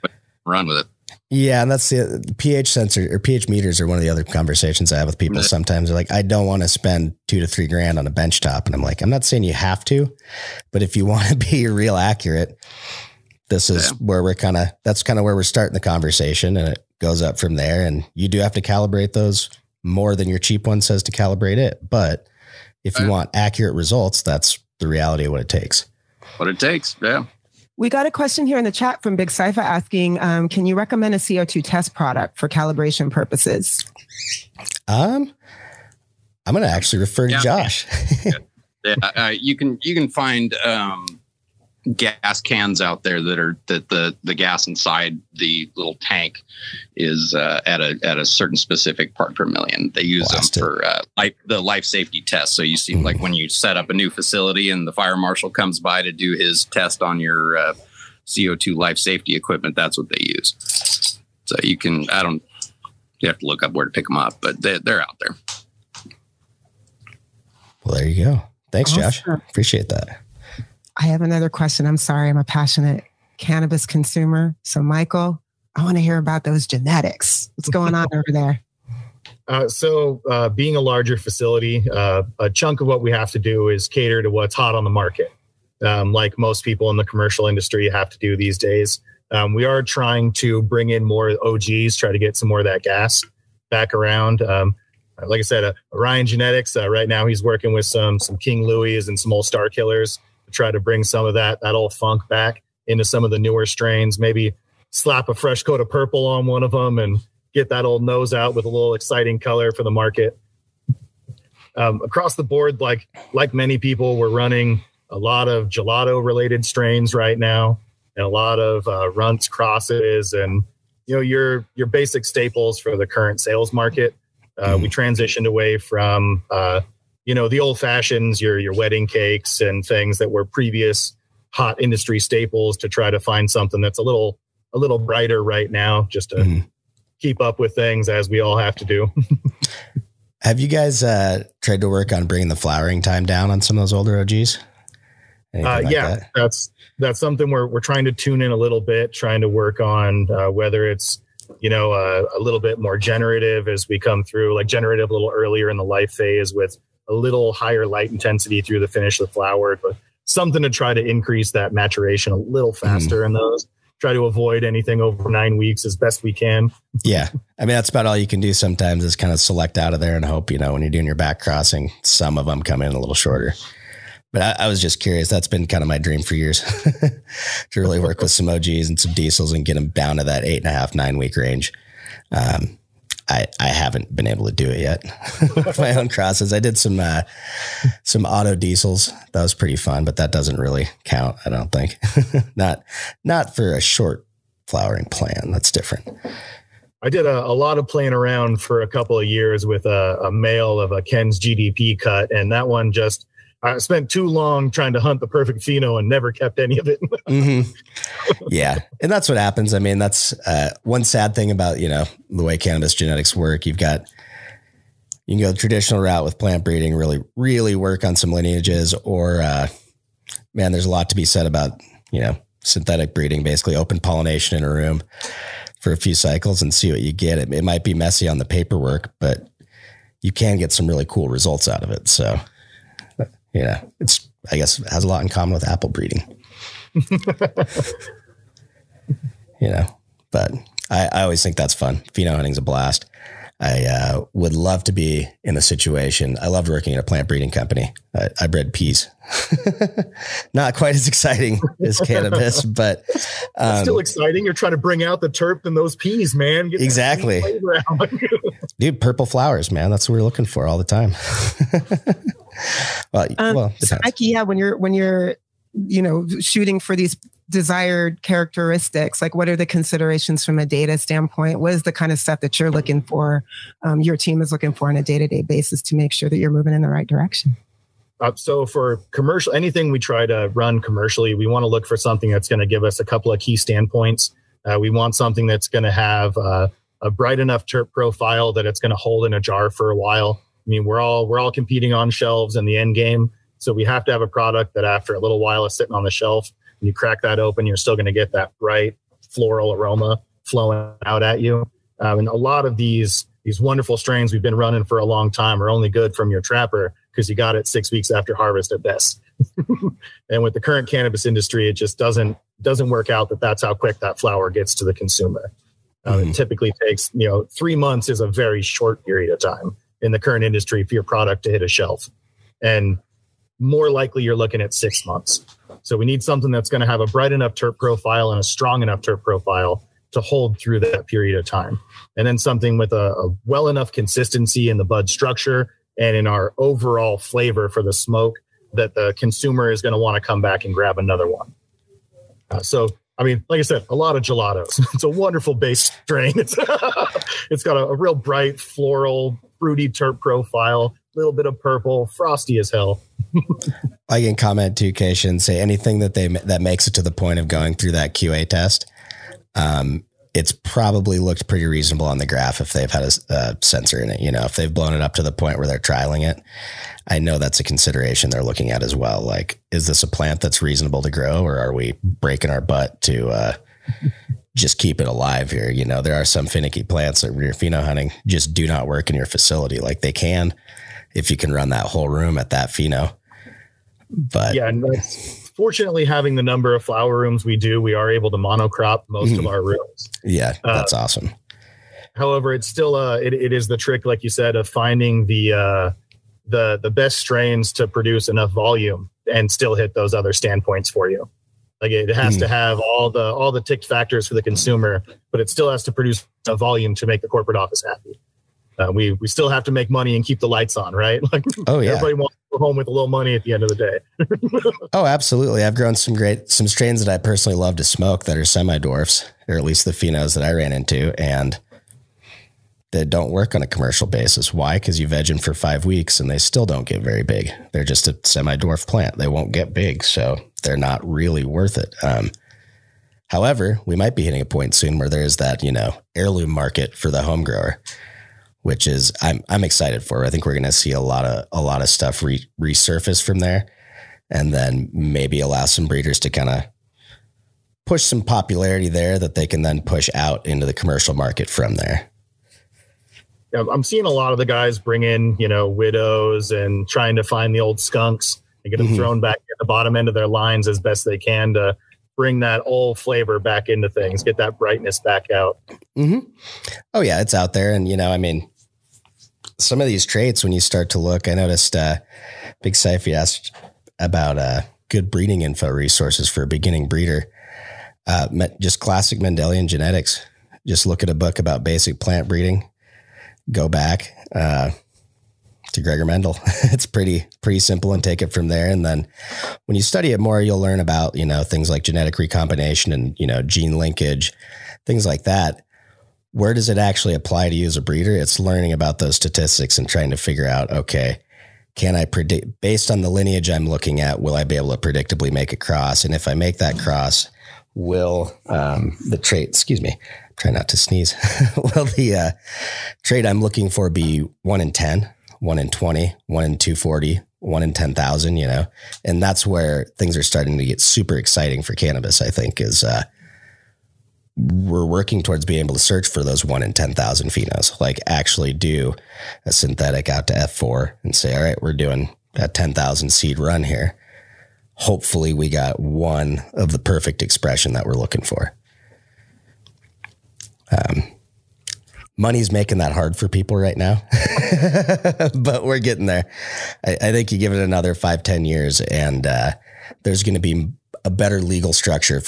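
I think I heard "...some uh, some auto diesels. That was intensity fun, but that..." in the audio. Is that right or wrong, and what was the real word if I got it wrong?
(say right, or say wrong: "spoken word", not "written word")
wrong: "pretty", not "intensity".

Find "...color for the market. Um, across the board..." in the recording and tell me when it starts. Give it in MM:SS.
01:49.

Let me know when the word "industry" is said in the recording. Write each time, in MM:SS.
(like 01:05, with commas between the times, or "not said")
01:27, 02:11, 05:11, 05:20.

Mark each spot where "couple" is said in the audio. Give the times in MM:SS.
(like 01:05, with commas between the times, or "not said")
03:18, 04:43.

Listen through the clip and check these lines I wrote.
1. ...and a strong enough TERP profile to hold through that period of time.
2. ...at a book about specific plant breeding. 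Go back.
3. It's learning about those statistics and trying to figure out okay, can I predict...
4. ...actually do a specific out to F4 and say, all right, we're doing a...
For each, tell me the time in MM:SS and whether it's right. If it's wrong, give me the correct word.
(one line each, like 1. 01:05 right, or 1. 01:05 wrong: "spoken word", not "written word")
1. 05:28 right
2. 08:01 wrong: "basic", not "specific"
3. 08:18 right
4. 08:48 wrong: "synthetic", not "specific".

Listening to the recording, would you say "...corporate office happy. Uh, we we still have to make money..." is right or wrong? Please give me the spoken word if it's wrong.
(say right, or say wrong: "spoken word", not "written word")
right.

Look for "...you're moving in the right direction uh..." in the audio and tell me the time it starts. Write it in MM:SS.
04:36.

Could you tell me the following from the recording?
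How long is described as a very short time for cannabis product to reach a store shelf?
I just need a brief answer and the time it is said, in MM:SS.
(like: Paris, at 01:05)
3 months, at 05:17.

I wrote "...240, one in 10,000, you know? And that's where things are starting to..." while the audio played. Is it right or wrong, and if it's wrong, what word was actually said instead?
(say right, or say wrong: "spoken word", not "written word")
right.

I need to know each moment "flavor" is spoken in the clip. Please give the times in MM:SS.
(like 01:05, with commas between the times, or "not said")
05:37, 07:42.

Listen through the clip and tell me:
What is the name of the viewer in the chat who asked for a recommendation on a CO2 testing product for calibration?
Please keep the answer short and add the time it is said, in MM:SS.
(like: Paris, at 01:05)
Big Cypher, at 00:29.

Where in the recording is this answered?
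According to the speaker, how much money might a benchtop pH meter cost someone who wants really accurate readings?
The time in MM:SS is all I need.
00:07.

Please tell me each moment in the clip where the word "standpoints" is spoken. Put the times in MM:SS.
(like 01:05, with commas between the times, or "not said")
04:30, 04:43, 06:40.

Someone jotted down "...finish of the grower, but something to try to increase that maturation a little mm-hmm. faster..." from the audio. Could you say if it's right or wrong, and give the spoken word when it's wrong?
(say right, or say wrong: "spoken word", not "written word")
wrong: "flower", not "grower".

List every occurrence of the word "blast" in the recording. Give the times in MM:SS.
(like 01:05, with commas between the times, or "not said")
00:50, 04:02.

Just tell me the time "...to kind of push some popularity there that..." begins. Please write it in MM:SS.
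07:26.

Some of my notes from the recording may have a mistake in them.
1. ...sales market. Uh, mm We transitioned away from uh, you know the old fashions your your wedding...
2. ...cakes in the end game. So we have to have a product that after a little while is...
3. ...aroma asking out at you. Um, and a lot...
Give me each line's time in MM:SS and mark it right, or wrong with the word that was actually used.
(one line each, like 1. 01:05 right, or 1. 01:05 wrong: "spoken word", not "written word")
1. 02:03 right
2. 04:52 wrong: "shelves", not "cakes"
3. 04:59 wrong: "flowing", not "asking".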